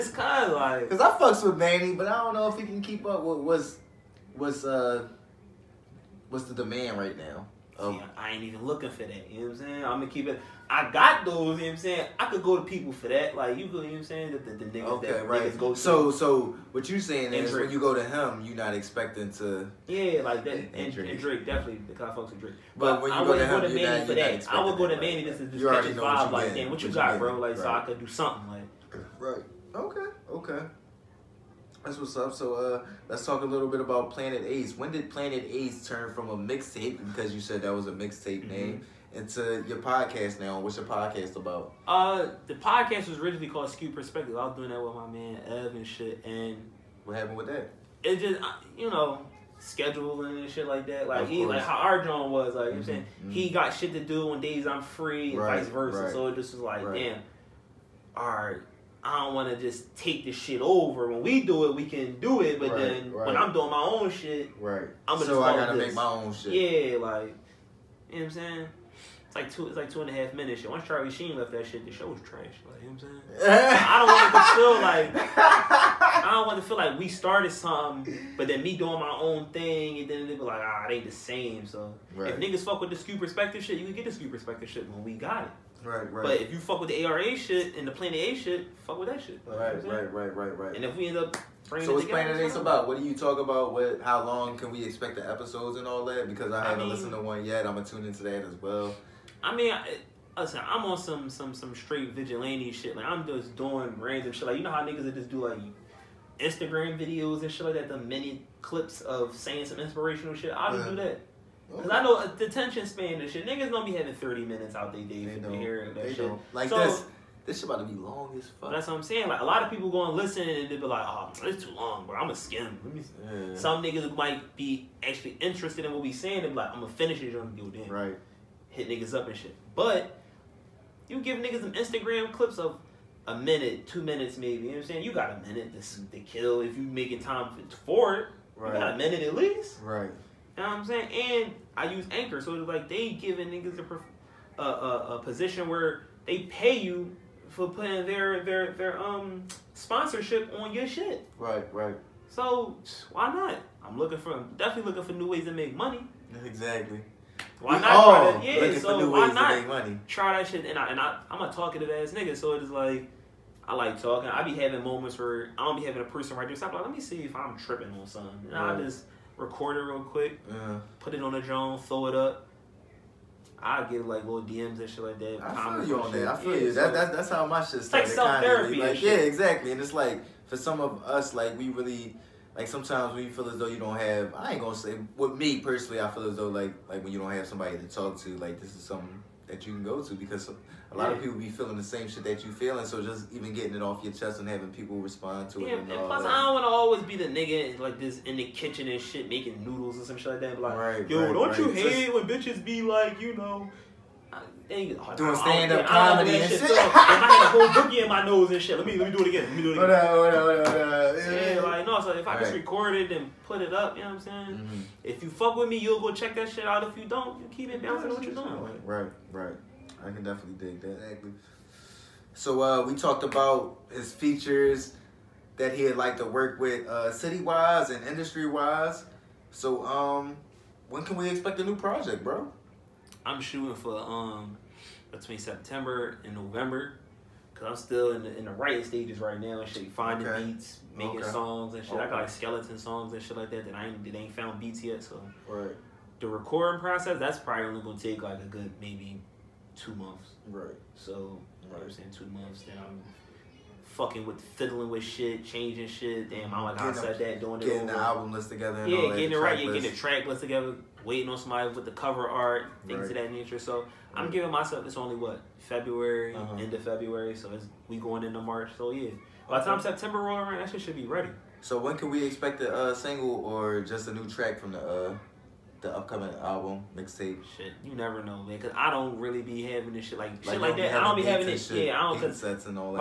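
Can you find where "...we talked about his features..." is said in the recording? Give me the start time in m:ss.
3:42.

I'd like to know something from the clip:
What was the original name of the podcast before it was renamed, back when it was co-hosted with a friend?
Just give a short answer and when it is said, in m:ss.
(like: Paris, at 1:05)
Skewed Perspective, at 0:43.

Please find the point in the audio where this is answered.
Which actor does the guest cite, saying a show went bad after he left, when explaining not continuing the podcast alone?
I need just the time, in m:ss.
1:10.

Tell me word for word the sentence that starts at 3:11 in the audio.
of people be feeling the same shit that you feeling.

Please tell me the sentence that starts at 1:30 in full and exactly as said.
And if we end up so what's Planet Ase about?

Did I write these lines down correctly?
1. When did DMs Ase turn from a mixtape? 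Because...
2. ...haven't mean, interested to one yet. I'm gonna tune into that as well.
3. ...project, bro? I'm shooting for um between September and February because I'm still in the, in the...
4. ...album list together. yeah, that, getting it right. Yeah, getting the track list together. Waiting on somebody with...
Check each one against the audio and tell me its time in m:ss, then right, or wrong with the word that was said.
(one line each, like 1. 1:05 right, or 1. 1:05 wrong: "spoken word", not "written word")
1. 0:34 wrong: "Planet", not "DMs"
2. 1:36 wrong: "listened", not "interested"
3. 3:51 wrong: "November", not "February"
4. 4:17 right.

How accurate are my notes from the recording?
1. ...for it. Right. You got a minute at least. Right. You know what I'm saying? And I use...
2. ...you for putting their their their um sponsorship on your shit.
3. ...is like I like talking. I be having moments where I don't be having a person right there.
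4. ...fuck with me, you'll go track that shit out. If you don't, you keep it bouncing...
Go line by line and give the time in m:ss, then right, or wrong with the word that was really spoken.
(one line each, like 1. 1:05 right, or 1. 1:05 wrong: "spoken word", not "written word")
1. 2:17 right
2. 2:26 right
3. 2:42 right
4. 3:35 wrong: "check", not "track".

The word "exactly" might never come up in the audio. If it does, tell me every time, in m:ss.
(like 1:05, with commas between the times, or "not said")
2:36, 2:59.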